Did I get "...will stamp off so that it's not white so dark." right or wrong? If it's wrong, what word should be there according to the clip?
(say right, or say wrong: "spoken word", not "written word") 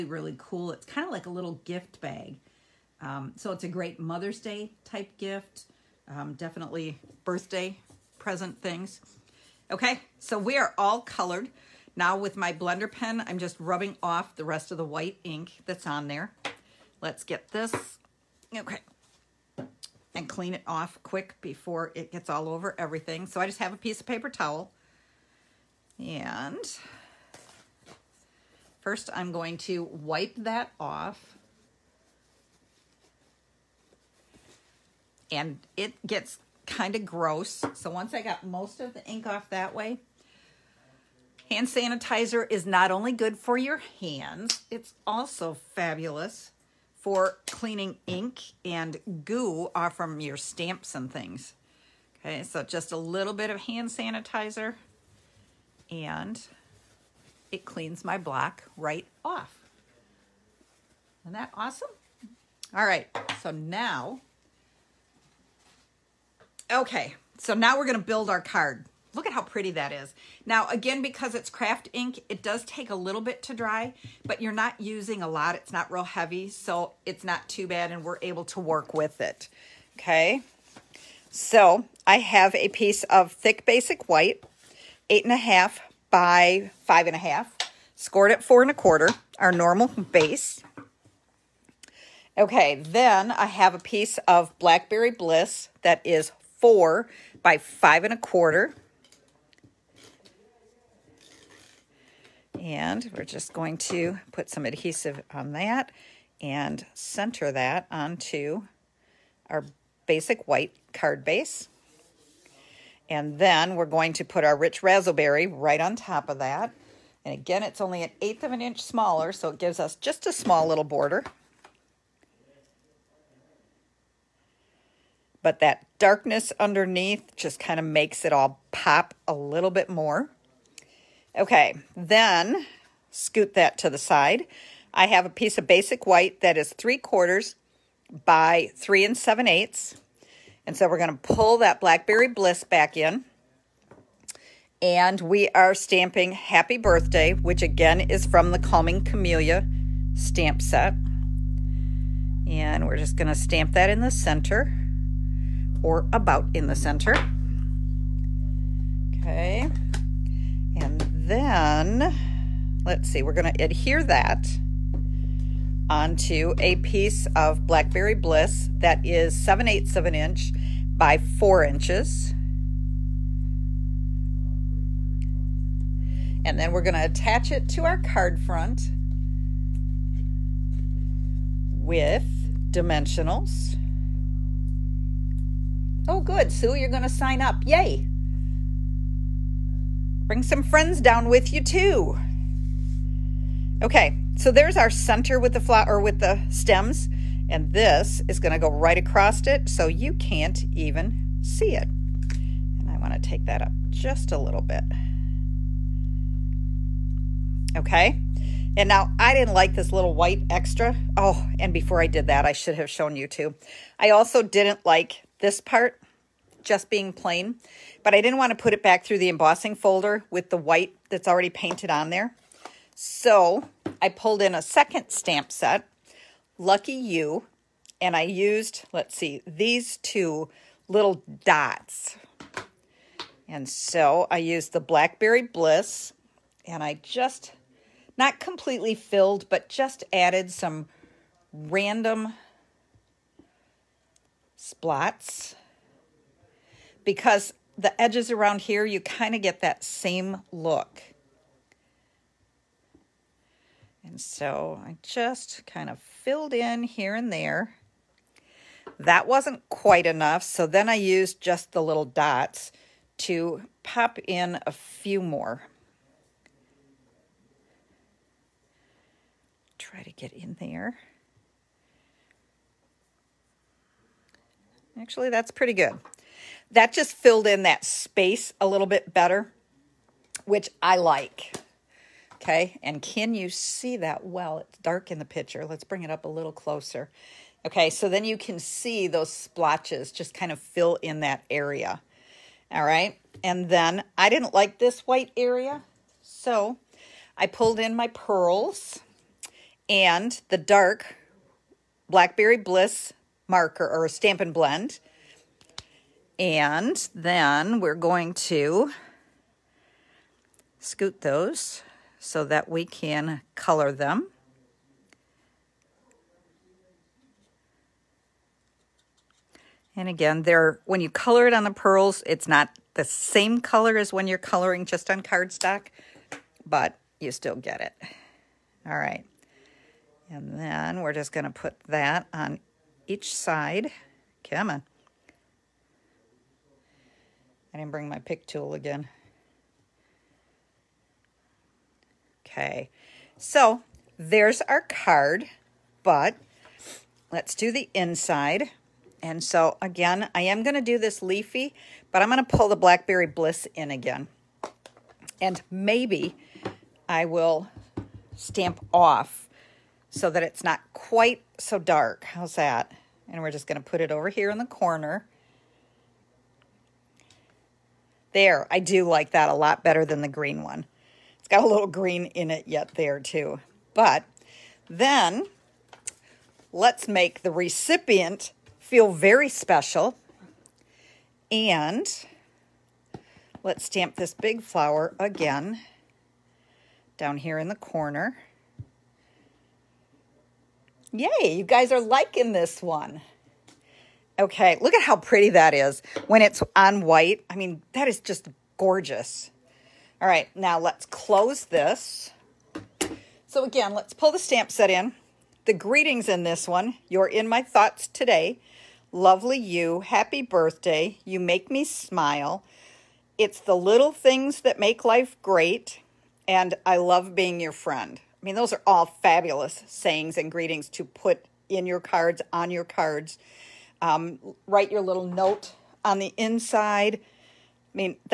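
wrong: "quite", not "white".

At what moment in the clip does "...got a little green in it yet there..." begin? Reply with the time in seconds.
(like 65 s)
371 s.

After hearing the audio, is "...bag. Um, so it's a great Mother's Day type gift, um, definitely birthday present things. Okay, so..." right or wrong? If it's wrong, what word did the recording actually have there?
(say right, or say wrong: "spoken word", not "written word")
right.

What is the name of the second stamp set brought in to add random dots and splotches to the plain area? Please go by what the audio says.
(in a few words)
Lucky You.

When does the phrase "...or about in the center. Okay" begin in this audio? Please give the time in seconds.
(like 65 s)
155 s.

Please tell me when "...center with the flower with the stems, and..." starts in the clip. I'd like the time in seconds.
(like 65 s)
194 s.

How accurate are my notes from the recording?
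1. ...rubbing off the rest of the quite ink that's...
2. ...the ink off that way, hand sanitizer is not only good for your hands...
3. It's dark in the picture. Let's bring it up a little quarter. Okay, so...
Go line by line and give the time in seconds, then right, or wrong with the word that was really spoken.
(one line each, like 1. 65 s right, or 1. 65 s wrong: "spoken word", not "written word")
1. 13 s wrong: "white", not "quite"
2. 38 s right
3. 284 s wrong: "closer", not "quarter".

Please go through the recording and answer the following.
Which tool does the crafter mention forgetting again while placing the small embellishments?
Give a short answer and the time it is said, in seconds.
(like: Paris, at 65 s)
Pick tool, at 338 s.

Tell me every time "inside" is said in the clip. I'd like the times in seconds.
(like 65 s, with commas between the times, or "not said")
347 s, 426 s.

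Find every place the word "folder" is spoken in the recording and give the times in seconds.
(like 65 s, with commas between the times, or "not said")
219 s.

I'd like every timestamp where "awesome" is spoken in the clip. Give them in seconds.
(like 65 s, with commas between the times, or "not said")
61 s.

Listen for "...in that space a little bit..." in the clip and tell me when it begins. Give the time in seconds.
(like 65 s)
277 s.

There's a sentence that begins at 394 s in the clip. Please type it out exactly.
Okay, look at how pretty that is when it's on white.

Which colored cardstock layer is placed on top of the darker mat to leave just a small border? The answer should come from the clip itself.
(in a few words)
Rich Razzleberry.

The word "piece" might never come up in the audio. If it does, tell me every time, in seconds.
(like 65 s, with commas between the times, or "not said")
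23 s, 82 s, 93 s, 135 s, 166 s.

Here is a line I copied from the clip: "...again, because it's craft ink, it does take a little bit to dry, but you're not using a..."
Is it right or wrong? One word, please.
right.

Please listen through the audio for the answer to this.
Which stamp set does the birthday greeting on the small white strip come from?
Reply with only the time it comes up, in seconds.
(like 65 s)
148 s.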